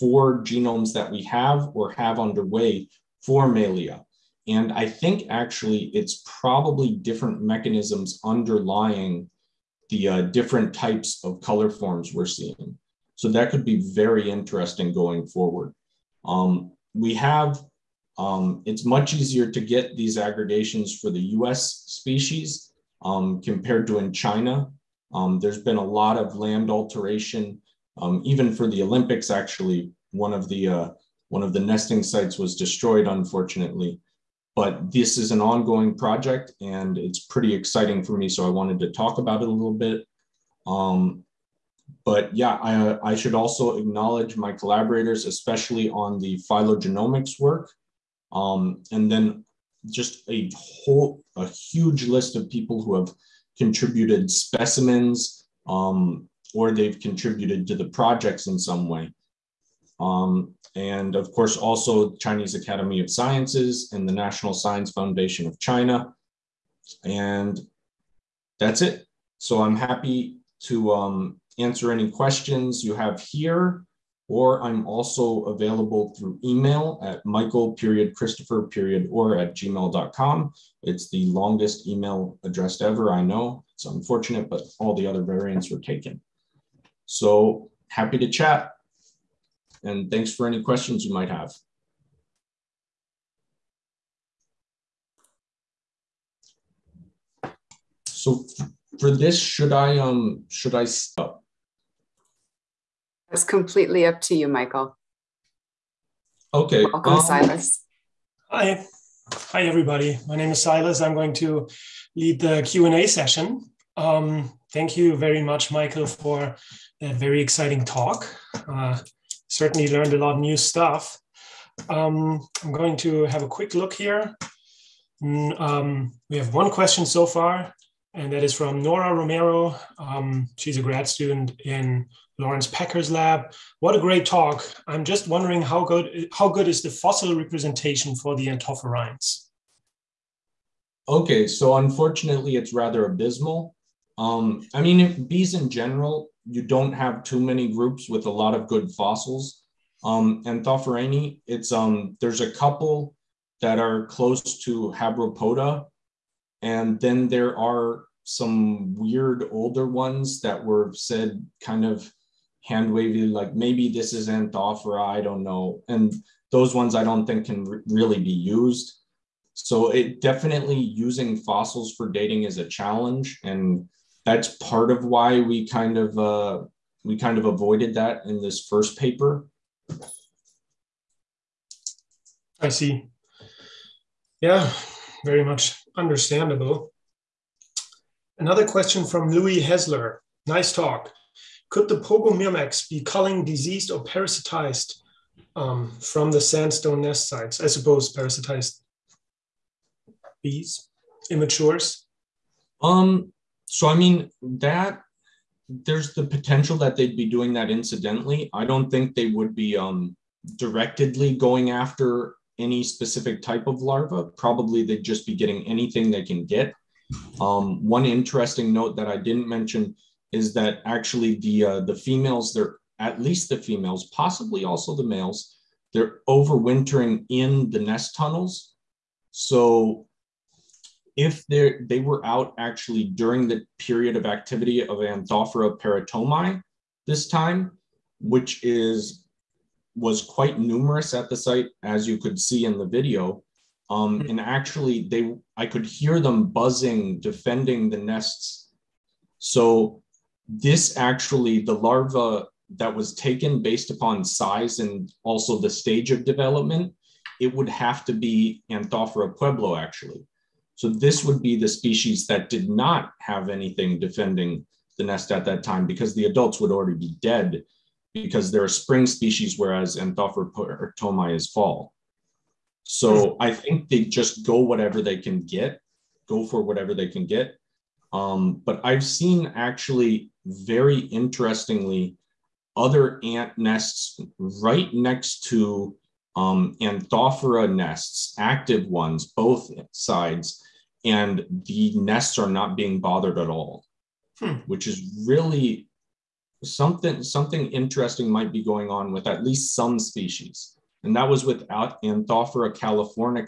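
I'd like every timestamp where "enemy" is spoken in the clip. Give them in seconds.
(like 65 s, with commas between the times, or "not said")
not said.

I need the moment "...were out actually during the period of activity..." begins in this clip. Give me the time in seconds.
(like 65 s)
232 s.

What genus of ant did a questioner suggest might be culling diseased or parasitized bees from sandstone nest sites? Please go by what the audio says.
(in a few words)
Pogonomyrmex.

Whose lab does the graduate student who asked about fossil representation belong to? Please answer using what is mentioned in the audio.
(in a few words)
Lawrence Packer.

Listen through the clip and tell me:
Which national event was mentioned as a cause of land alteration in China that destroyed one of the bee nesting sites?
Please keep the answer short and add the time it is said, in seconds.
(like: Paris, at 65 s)
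The Olympics, at 28 s.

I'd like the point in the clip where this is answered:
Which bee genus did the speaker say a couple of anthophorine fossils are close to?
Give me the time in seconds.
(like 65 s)
154 s.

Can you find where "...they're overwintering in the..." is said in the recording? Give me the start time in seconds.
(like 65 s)
225 s.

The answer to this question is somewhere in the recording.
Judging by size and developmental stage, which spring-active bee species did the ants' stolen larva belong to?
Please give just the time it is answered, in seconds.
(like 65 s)
258 s.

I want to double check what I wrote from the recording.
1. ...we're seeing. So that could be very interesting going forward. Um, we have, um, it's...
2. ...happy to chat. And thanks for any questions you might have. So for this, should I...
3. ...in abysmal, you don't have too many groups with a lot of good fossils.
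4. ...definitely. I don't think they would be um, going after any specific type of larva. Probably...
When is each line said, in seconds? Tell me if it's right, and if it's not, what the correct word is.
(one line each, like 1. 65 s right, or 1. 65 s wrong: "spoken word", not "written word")
1. 12 s right
2. 87 s right
3. 145 s wrong: "general", not "abysmal"
4. 207 s wrong: "incidentally", not "definitely".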